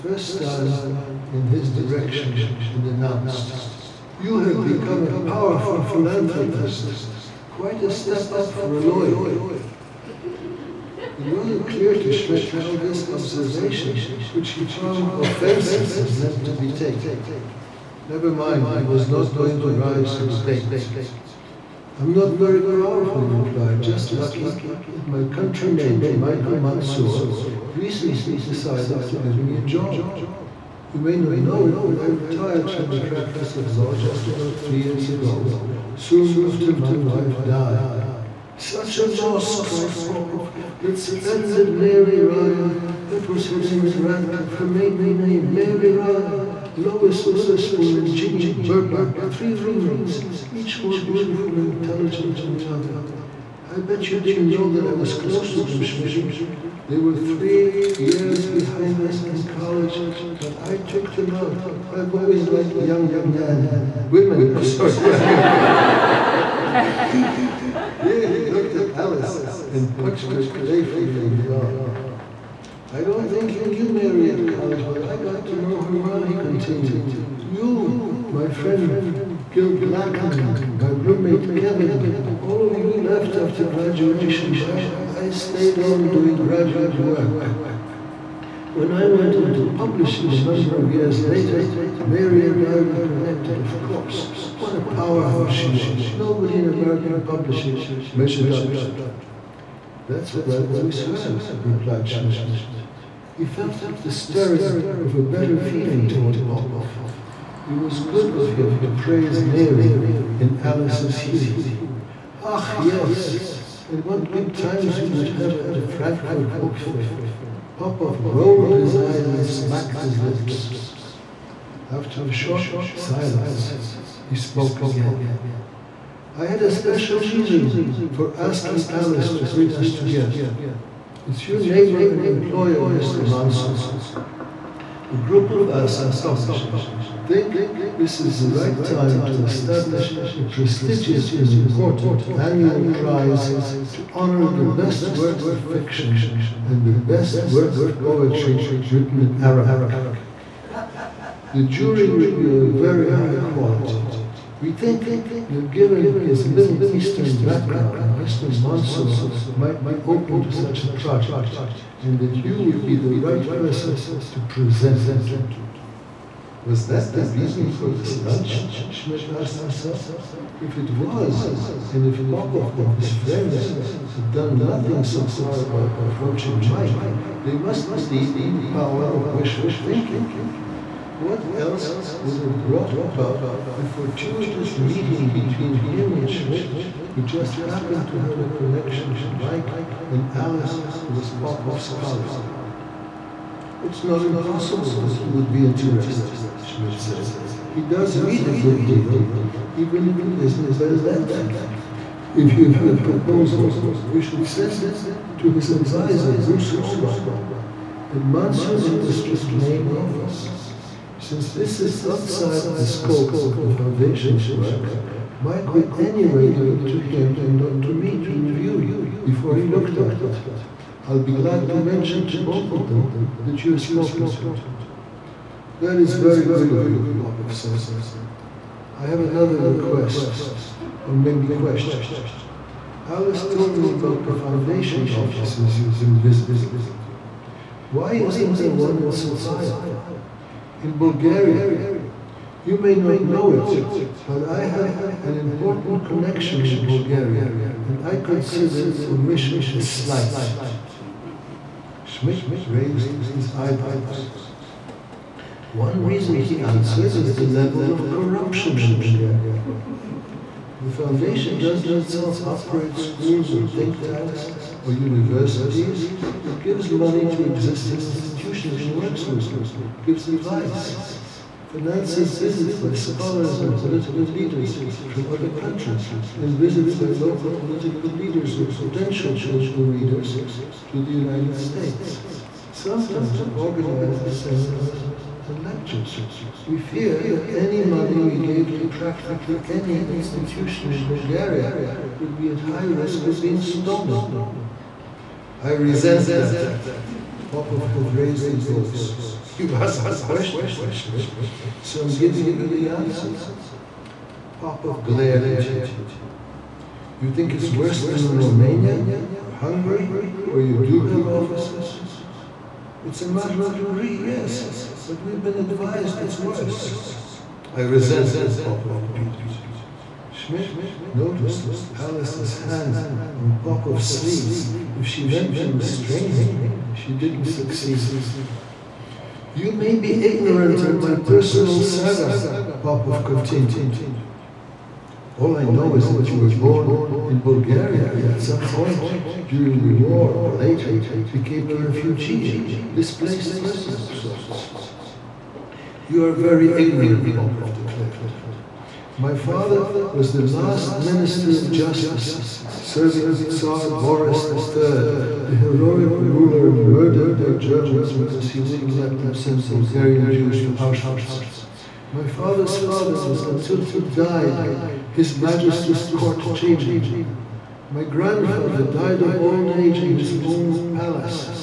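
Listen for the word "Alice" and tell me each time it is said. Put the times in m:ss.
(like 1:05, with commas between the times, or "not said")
1:08, 1:50, 2:08, 3:10, 3:53, 5:22.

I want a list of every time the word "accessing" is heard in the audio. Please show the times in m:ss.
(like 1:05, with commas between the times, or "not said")
not said.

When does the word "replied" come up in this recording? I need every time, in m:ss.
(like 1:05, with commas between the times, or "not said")
0:23, 1:41.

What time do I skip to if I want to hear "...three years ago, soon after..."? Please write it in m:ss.
0:34.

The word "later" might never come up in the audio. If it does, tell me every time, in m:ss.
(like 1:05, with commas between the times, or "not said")
1:31, 5:40.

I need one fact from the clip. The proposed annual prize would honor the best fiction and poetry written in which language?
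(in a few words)
Arabic.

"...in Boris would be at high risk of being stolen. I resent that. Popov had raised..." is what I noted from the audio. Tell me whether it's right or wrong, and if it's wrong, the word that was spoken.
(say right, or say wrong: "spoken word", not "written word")
wrong: "Bulgaria", not "Boris".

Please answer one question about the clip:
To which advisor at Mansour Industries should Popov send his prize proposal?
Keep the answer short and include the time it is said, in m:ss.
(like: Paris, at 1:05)
Bruce Holbein, at 3:26.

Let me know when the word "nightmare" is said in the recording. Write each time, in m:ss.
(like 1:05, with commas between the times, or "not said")
not said.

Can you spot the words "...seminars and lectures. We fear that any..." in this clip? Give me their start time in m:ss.
4:44.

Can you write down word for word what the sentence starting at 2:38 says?
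Mansour might be open to such a project and that you would be the right person to present it to.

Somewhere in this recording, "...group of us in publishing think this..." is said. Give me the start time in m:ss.
2:15.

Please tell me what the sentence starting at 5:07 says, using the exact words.
You think it's worse than in Romania or Hungary where you do have officers?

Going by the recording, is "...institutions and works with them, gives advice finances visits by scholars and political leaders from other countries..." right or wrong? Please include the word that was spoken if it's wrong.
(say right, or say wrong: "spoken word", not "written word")
right.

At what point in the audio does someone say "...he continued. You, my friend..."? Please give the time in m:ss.
1:16.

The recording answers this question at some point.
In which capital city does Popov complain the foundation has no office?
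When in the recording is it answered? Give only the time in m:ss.
3:59.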